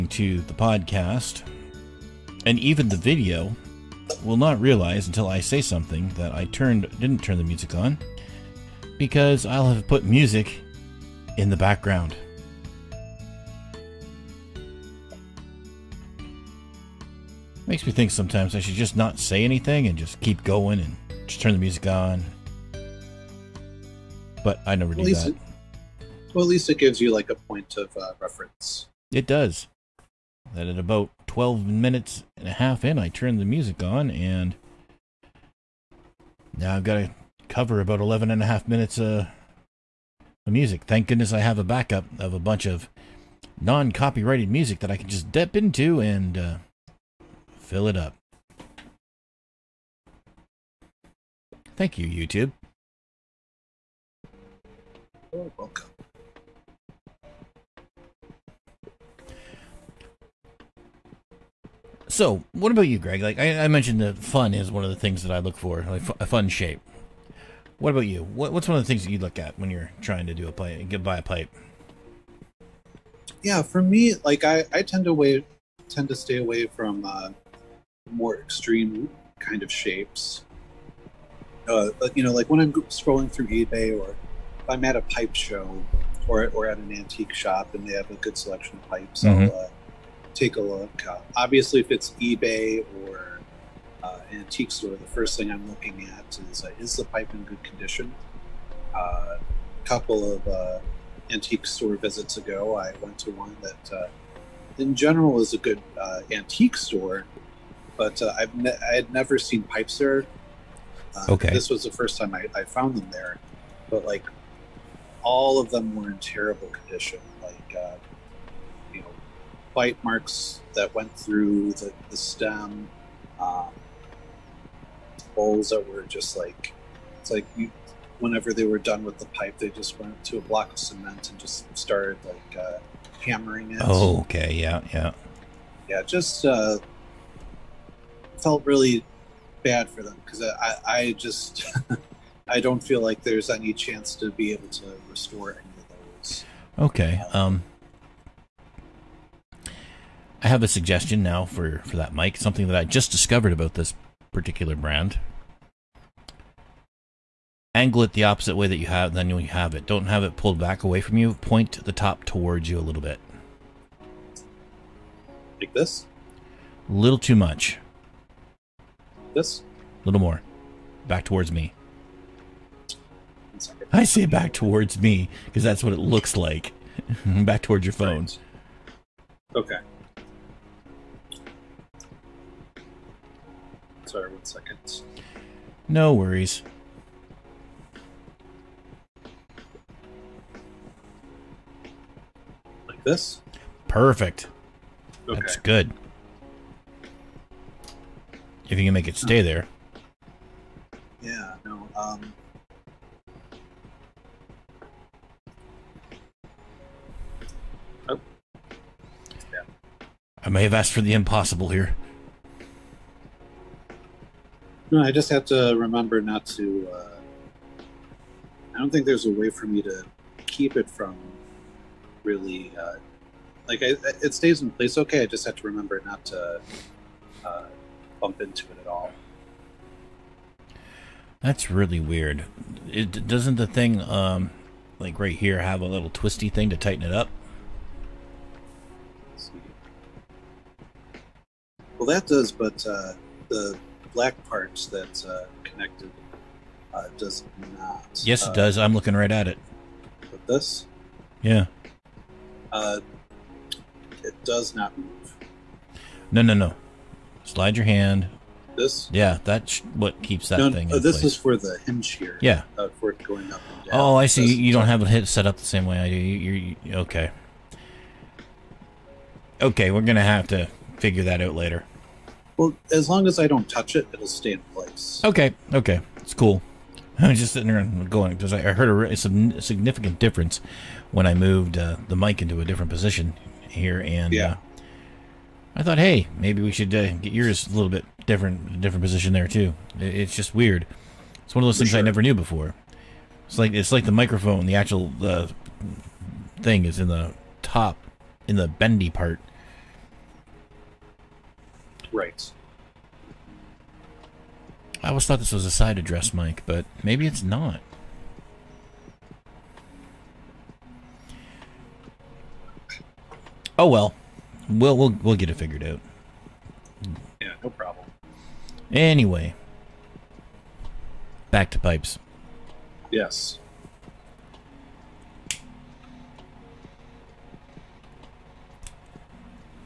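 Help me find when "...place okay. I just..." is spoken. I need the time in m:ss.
3:44.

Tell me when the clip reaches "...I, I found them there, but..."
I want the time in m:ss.
1:52.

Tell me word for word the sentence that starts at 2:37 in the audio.
Angle it the opposite way that you have than you have it.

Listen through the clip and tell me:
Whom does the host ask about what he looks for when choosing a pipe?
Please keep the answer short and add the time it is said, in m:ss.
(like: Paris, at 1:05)
Greg, at 1:02.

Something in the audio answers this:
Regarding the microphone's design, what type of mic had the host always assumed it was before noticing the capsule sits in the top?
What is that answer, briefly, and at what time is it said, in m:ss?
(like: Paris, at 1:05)
side address mic, at 5:05.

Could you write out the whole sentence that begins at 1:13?
Yeah, for me, like I, I tend to tend to stay away from uh, more extreme kind of shapes.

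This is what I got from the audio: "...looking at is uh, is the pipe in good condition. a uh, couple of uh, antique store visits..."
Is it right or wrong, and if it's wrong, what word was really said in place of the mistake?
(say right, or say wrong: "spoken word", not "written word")
right.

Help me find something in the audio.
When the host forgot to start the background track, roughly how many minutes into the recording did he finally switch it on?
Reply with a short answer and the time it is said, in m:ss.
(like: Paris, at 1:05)
12 and a half minutes, at 0:31.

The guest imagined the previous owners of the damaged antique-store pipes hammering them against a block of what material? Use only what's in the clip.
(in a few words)
cement.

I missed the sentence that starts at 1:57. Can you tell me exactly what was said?
Like bite marks that went through the, the stem, um, holes that were just like it's like you.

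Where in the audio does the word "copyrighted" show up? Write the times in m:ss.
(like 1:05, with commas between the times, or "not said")
0:43.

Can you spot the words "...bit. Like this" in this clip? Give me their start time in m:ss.
2:43.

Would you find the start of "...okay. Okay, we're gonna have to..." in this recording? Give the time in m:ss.
4:26.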